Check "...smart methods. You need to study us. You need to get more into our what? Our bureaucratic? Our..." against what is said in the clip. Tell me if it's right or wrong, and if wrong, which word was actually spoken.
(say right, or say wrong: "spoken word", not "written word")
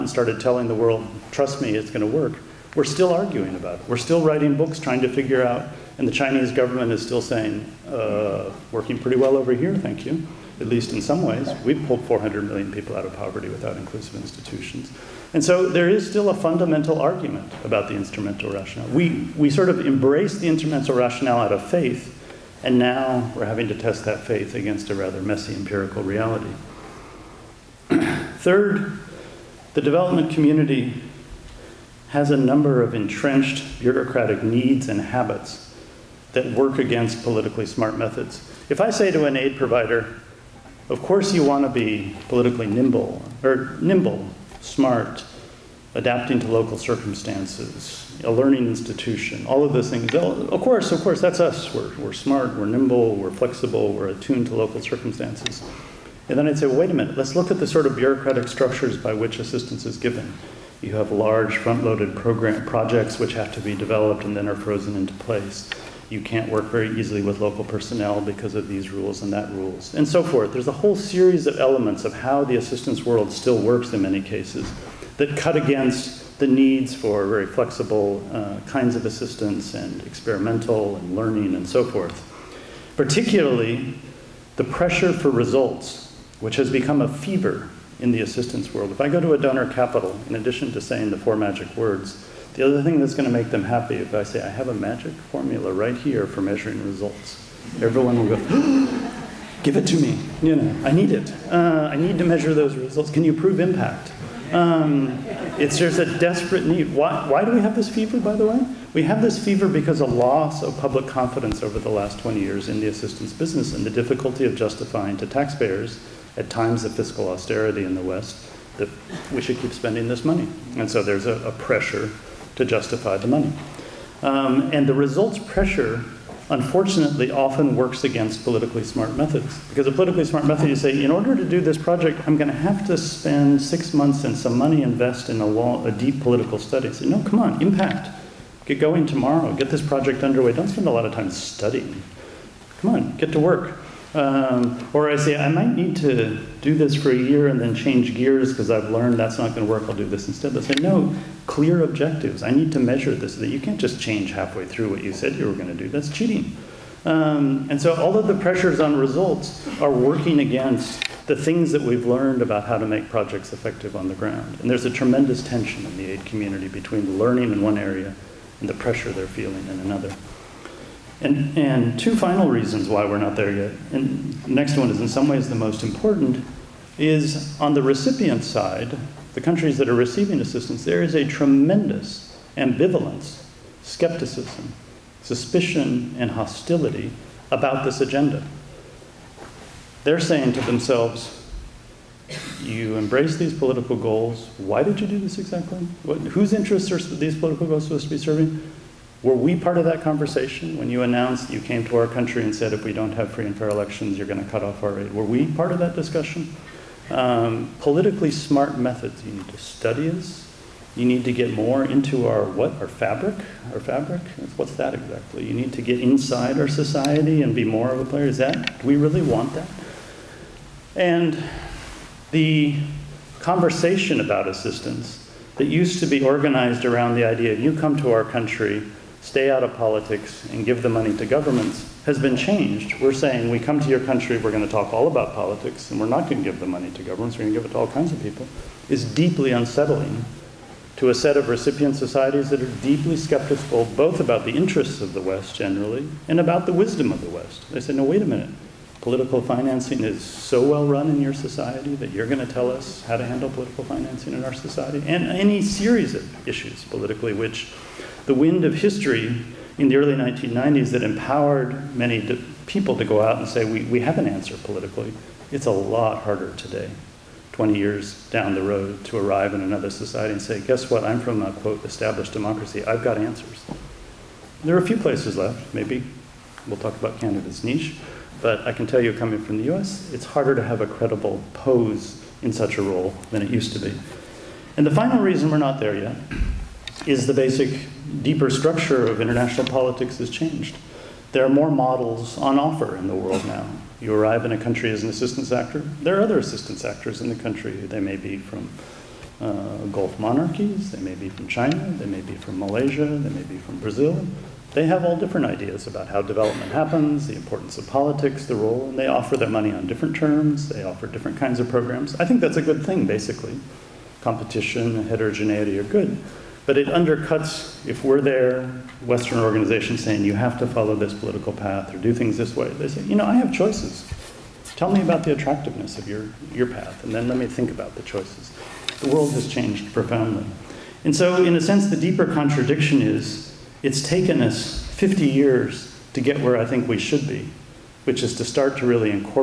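wrong: "fabric", not "bureaucratic".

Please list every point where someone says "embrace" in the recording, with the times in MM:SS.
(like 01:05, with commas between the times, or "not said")
00:19, 03:12.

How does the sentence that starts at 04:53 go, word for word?
You arrive in a country as an assistance actor.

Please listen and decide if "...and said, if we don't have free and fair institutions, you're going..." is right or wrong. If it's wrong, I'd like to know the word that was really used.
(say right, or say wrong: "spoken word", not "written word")
wrong: "elections", not "institutions".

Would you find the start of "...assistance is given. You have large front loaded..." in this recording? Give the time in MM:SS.
00:59.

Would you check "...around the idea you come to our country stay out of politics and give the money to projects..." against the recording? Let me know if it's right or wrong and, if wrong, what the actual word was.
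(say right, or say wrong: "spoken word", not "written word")
wrong: "governments", not "projects".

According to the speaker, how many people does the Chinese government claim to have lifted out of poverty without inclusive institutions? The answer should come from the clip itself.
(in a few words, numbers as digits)
400 million.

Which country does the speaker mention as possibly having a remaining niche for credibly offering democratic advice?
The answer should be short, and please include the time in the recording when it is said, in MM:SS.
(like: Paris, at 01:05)
Canada, at 04:37.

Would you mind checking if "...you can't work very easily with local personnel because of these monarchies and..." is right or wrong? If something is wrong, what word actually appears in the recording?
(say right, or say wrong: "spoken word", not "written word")
wrong: "rules", not "monarchies".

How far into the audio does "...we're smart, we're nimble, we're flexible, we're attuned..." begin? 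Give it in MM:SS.
00:51.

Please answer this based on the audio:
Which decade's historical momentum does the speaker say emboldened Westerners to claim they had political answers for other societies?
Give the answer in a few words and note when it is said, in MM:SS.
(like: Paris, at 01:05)
early 1990s, at 04:19.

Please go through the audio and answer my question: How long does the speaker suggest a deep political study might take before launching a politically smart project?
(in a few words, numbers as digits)
6 months.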